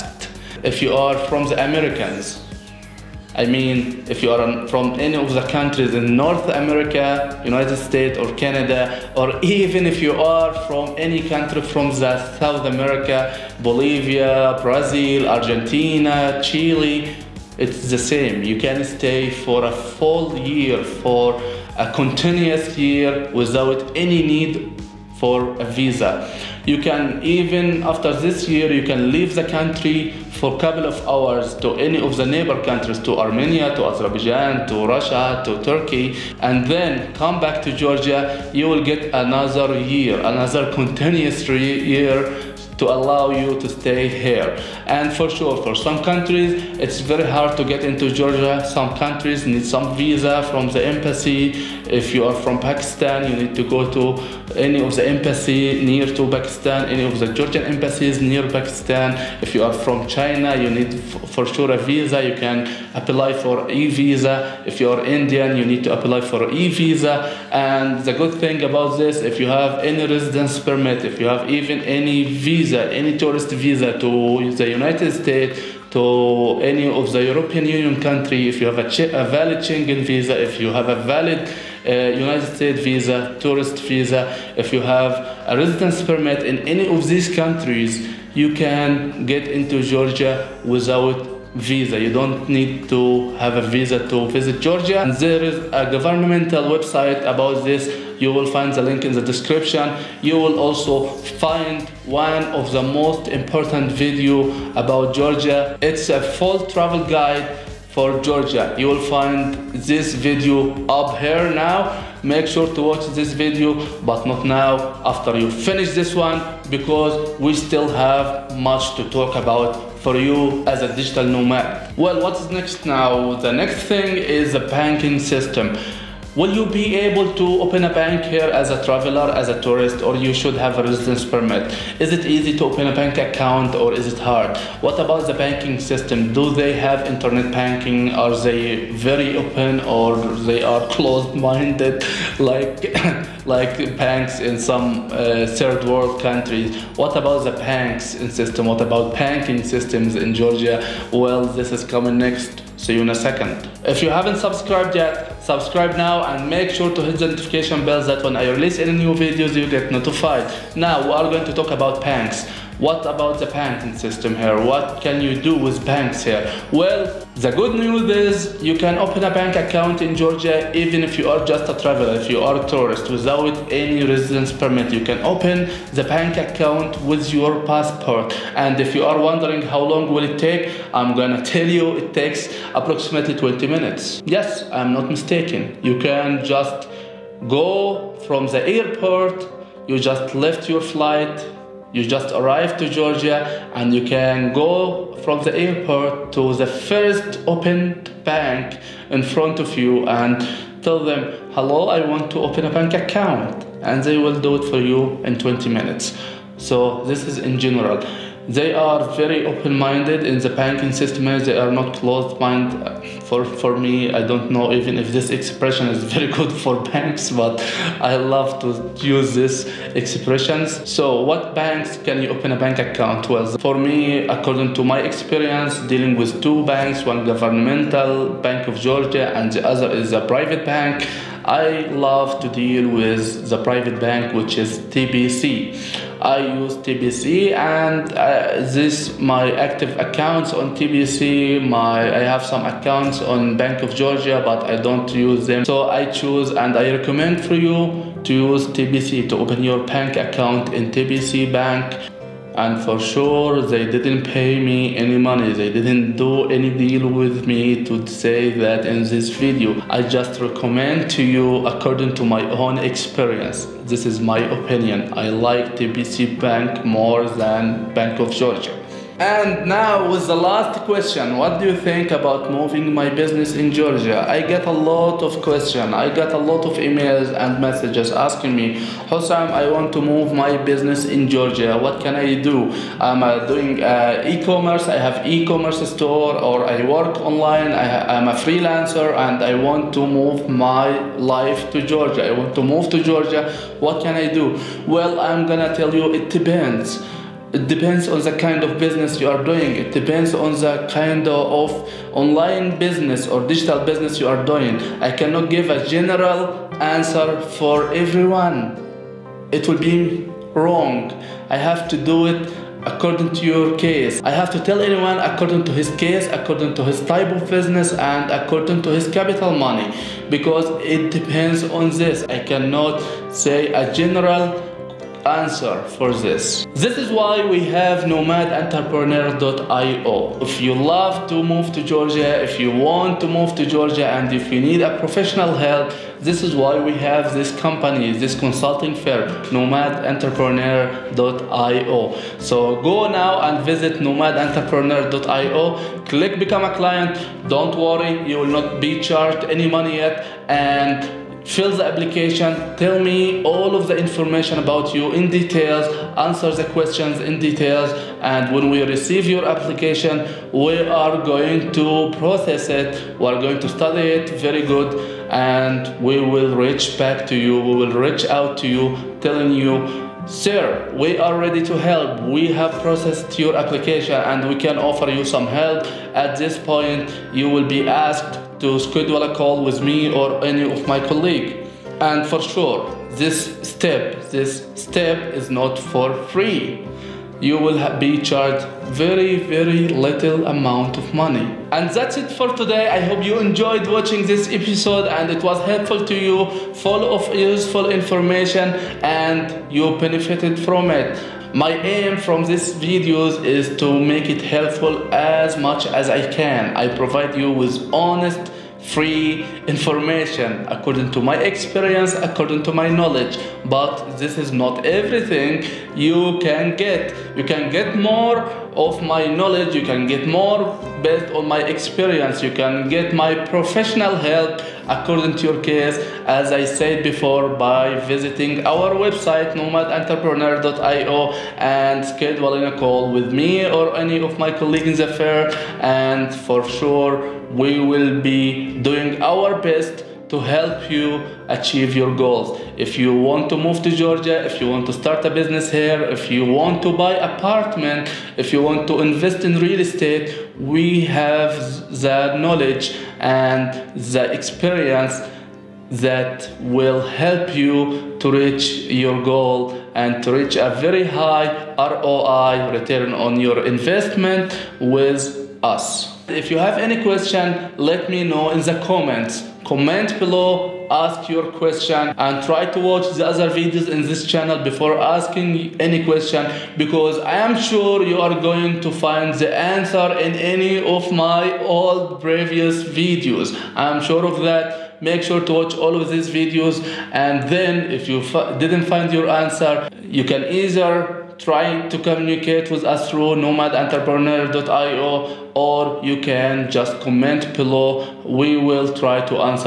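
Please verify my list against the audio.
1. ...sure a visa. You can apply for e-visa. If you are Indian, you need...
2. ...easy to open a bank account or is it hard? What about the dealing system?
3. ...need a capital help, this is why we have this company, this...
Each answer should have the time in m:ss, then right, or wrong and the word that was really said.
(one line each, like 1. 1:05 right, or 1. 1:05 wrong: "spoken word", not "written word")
1. 1:01 right
2. 2:12 wrong: "banking", not "dealing"
3. 5:34 wrong: "professional", not "capital".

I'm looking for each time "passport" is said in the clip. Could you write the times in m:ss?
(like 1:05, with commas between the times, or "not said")
2:57.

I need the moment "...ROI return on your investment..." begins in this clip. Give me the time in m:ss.
7:41.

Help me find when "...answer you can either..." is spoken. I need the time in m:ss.
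8:09.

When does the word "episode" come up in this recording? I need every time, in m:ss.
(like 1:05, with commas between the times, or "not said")
6:34.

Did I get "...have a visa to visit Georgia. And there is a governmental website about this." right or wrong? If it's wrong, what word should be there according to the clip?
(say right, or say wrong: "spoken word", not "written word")
right.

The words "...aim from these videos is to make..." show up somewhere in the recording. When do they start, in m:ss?
6:41.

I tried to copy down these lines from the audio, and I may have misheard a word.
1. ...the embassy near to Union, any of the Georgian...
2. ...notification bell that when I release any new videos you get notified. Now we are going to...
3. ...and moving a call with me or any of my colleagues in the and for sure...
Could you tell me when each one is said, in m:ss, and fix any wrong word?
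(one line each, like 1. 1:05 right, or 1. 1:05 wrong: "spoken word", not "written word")
1. 0:54 wrong: "Pakistan", not "Union"
2. 2:37 right
3. 7:11 wrong: "scheduling", not "moving".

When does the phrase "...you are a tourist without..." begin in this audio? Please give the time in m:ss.
2:52.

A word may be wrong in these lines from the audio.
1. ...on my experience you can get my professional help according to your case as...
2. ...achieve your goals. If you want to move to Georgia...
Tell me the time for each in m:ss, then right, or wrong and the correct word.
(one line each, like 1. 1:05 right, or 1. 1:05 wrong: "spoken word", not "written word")
1. 7:01 right
2. 7:21 right.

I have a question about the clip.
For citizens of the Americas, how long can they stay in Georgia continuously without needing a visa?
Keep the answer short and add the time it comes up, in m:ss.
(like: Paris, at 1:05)
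a full year, at 0:19.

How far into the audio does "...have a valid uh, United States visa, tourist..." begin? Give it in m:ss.
1:20.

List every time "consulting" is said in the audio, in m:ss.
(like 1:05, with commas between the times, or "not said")
5:38.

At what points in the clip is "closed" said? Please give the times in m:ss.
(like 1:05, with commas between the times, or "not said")
2:20, 3:31.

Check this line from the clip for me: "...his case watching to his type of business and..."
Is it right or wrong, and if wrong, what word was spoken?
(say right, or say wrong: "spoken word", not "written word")
wrong: "according", not "watching".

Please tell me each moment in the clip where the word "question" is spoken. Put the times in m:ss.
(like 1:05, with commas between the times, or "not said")
4:30, 4:35, 5:56, 7:47, 7:51, 7:56.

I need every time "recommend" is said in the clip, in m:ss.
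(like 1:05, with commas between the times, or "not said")
4:06, 4:20.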